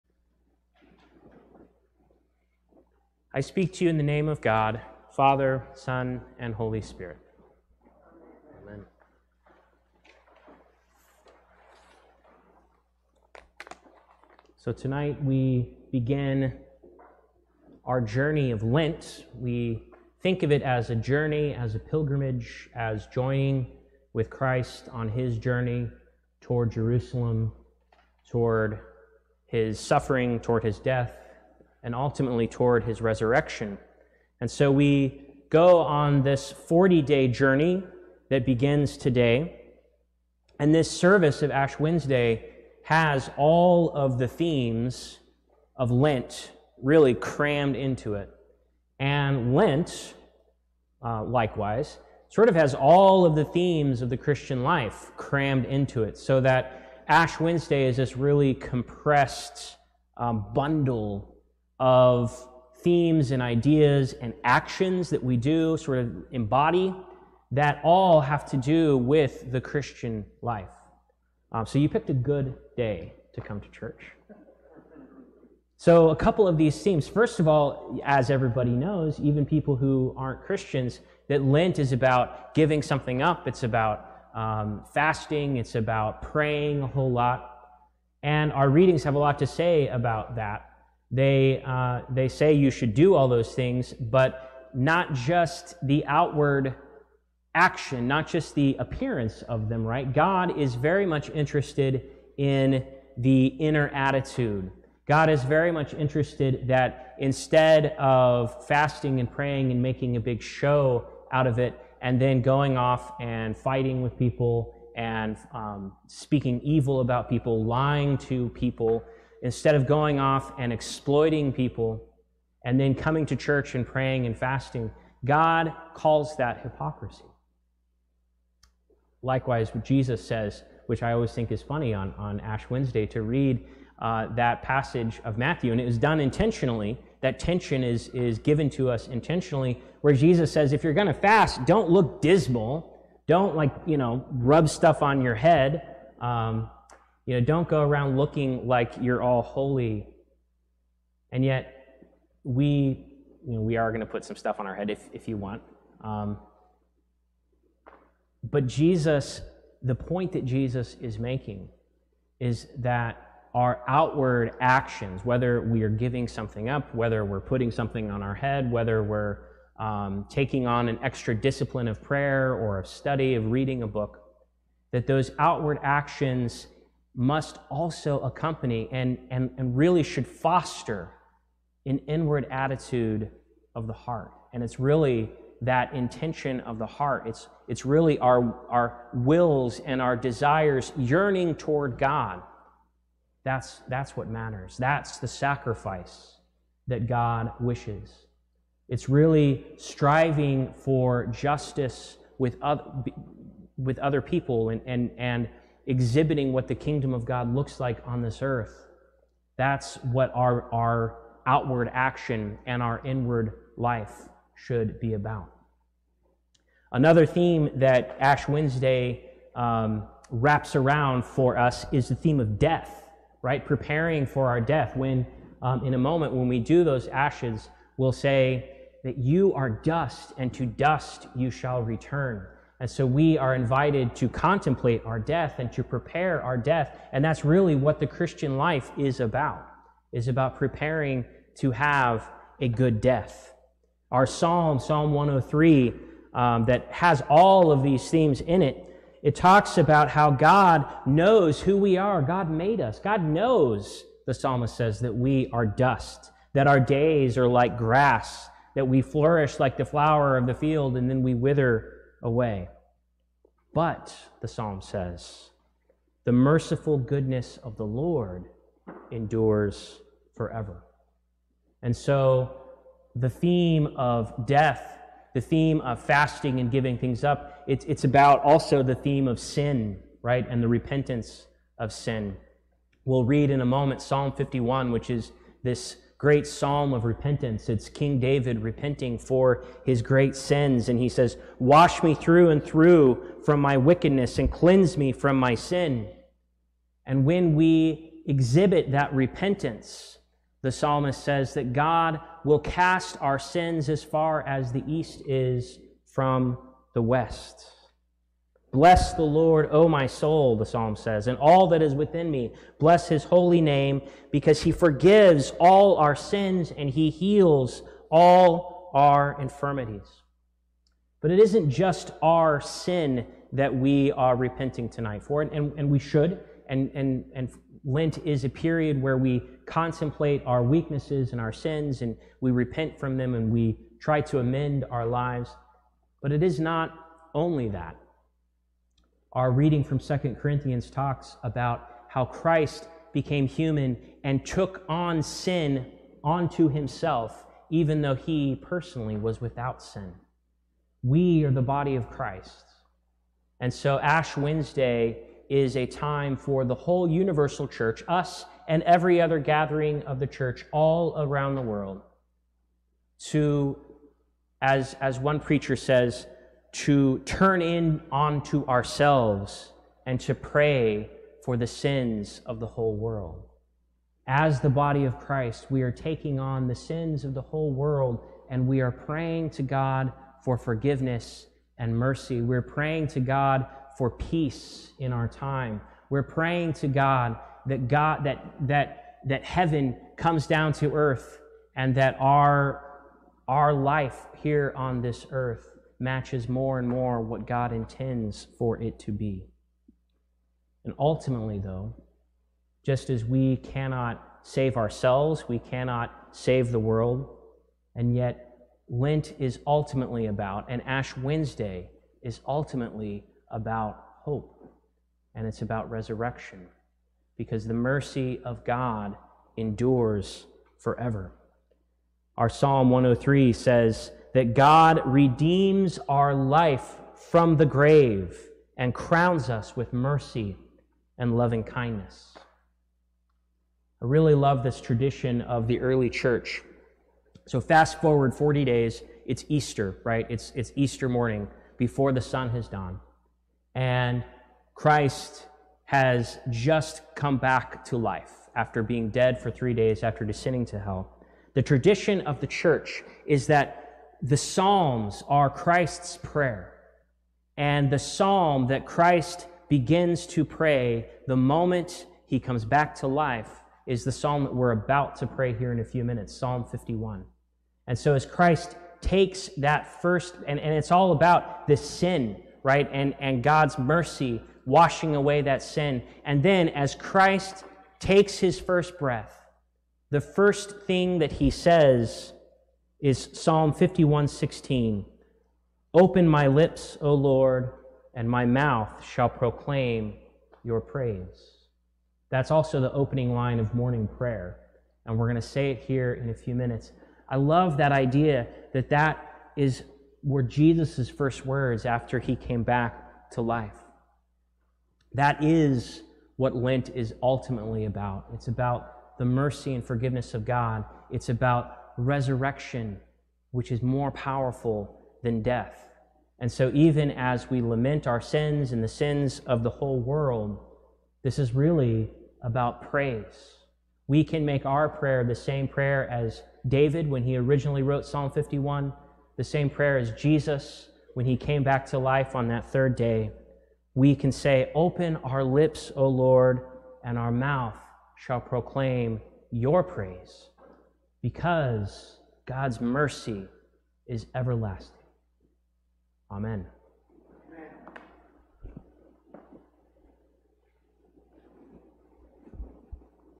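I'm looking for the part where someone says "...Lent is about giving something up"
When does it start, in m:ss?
1:21.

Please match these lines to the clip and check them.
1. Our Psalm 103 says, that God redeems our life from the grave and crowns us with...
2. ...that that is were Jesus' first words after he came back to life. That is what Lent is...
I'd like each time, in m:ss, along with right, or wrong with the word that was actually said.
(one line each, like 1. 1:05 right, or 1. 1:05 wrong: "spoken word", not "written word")
1. 7:02 right
2. 8:18 right.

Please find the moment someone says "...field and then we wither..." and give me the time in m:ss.
4:20.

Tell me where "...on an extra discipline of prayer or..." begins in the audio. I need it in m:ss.
2:50.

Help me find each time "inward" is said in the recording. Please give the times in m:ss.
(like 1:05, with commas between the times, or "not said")
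3:02, 3:33.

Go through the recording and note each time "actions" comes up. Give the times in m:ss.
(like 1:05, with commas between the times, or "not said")
1:04, 1:37, 2:44, 2:55, 3:31.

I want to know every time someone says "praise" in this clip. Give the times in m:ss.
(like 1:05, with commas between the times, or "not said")
8:10, 8:42, 8:59.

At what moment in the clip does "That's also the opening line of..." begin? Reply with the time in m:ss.
8:12.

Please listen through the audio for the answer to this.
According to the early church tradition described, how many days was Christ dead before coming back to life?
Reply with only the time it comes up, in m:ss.
7:29.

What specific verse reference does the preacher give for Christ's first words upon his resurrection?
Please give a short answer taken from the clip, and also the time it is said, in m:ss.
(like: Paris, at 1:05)
Psalm 51:16, at 8:03.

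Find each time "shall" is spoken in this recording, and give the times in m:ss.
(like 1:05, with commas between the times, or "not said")
3:51, 8:09, 8:58.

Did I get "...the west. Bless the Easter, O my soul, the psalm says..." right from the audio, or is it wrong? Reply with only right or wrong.
wrong.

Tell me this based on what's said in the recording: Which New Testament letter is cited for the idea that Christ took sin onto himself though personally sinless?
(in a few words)
Second Corinthians.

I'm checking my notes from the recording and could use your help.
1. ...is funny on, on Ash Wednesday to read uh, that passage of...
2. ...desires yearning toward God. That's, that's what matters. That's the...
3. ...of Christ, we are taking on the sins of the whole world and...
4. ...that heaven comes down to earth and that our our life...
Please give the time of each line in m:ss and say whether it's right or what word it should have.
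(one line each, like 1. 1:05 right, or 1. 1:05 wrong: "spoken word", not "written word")
1. 2:11 right
2. 3:10 right
3. 6:15 right
4. 6:29 right.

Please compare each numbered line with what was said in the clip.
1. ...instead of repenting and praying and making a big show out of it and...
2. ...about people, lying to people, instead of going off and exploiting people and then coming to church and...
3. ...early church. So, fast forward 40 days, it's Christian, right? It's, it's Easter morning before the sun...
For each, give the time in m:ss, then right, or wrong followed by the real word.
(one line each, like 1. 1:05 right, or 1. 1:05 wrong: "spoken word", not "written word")
1. 1:47 wrong: "fasting", not "repenting"
2. 1:57 right
3. 7:15 wrong: "Easter", not "Christian".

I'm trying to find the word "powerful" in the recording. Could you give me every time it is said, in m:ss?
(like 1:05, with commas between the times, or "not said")
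8:34.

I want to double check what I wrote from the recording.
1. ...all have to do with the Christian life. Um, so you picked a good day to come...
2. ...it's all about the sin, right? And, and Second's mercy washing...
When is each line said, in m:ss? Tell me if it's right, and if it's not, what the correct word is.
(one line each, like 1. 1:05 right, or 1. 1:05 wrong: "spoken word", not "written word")
1. 1:07 right
2. 7:50 wrong: "God", not "Second".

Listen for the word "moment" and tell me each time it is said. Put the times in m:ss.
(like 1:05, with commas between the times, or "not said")
3:45, 4:43, 7:41.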